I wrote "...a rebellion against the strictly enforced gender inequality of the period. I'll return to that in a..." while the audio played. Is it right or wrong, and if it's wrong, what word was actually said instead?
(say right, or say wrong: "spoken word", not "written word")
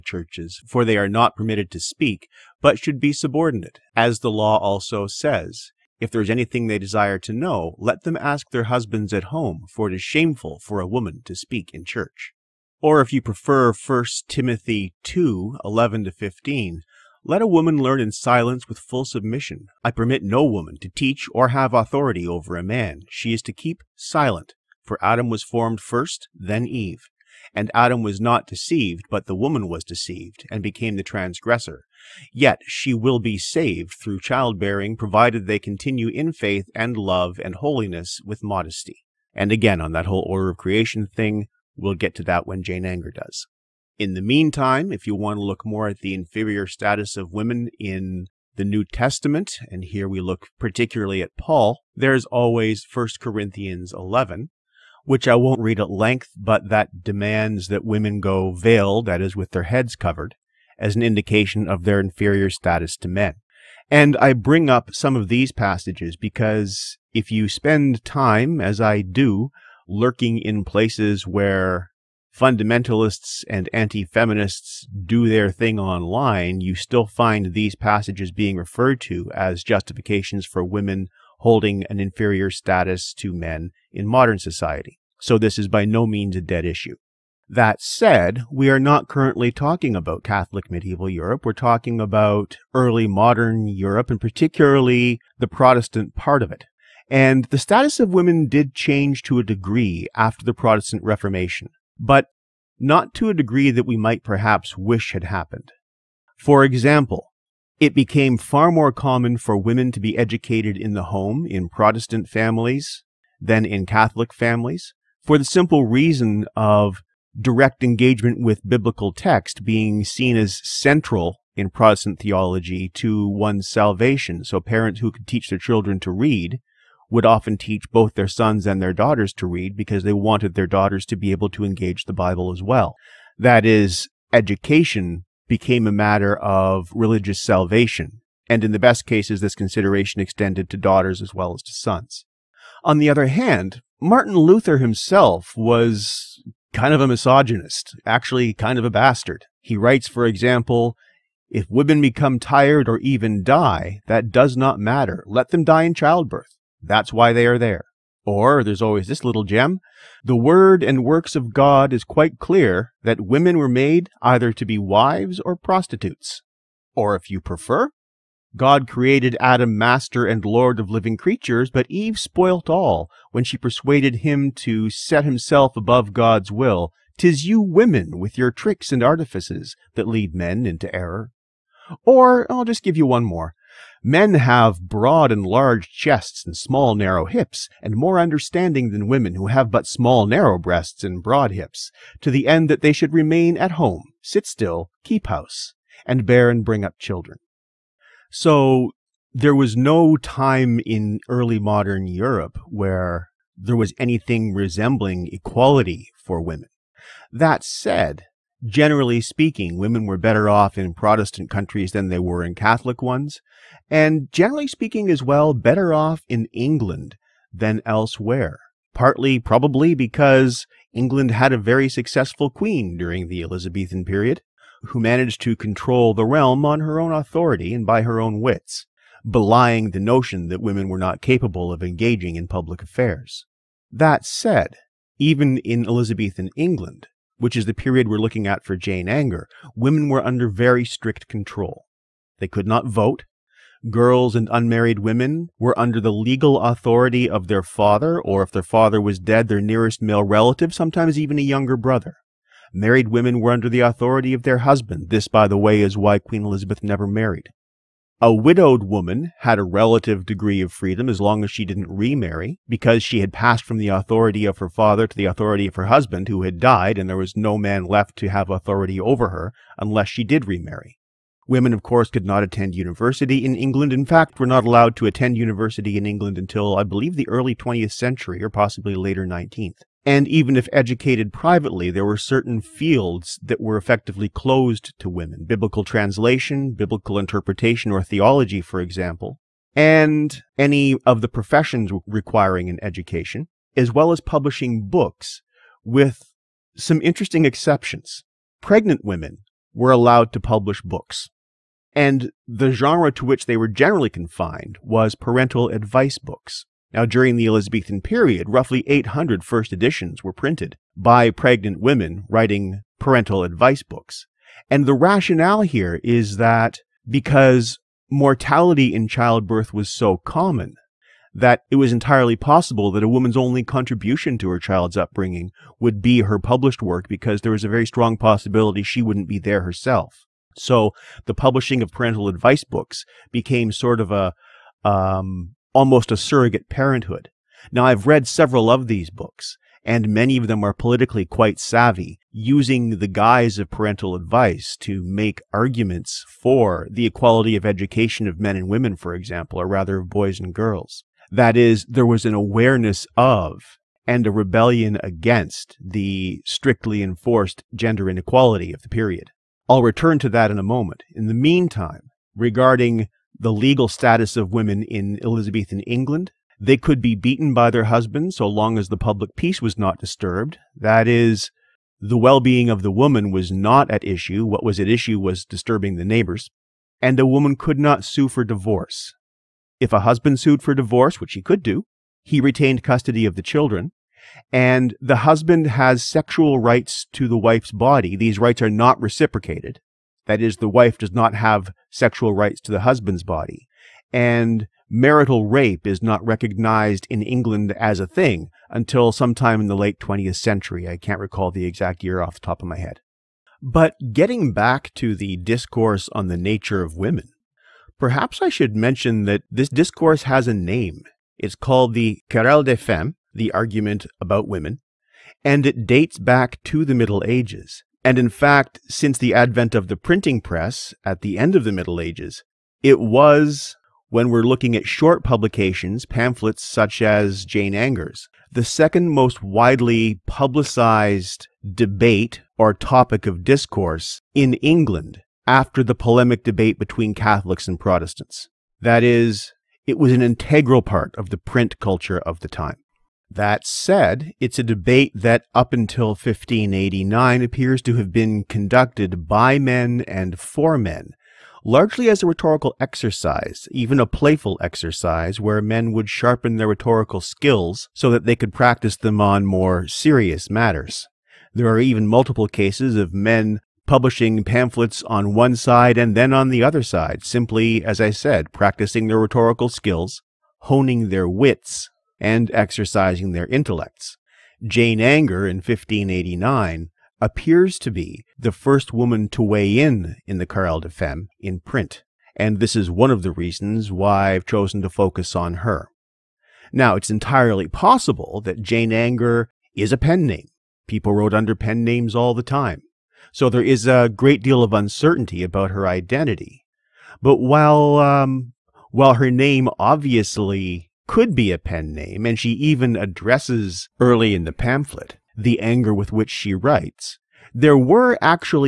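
right.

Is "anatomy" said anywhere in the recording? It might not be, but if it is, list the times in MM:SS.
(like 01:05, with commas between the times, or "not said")
not said.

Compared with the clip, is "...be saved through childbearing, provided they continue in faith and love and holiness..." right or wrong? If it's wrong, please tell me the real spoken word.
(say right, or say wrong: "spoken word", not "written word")
right.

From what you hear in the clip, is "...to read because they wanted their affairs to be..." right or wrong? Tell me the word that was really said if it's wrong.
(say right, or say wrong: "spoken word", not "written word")
wrong: "daughters", not "affairs".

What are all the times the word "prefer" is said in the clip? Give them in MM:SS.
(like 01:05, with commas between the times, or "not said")
00:13, 02:47.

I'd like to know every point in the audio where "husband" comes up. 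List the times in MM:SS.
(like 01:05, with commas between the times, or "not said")
00:08, 04:14, 04:25, 06:07, 06:20, 06:25, 06:32.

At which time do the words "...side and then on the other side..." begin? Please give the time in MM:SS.
07:45.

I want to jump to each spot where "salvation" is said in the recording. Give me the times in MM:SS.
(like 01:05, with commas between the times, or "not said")
02:03, 02:17.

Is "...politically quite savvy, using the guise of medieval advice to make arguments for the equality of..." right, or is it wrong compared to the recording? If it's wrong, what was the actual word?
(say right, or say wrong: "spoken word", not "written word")
wrong: "parental", not "medieval".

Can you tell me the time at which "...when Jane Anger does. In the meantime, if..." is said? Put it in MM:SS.
00:42.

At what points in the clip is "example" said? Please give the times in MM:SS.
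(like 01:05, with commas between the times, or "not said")
01:46, 02:30, 04:48, 05:49.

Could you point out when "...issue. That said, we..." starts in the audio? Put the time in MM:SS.
01:26.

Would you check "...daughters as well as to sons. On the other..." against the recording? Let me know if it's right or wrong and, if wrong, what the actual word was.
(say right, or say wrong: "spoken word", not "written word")
right.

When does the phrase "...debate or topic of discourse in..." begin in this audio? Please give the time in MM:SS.
07:11.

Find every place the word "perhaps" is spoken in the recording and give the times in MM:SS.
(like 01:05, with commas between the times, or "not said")
01:44, 06:47.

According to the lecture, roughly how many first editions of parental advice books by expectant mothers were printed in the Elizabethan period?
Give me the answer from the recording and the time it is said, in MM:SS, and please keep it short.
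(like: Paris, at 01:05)
800, at 05:08.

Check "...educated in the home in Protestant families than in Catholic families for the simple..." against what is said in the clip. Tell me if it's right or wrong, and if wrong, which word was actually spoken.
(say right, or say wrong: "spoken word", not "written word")
right.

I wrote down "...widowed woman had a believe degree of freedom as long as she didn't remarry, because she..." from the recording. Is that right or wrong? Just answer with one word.
wrong.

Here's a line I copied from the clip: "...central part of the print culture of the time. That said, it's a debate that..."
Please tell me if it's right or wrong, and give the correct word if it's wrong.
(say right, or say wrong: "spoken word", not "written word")
wrong: "integral", not "central".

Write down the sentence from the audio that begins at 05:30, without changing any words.
So the publishing of parental advice books became sort of a um, almost a surrogate parenthood.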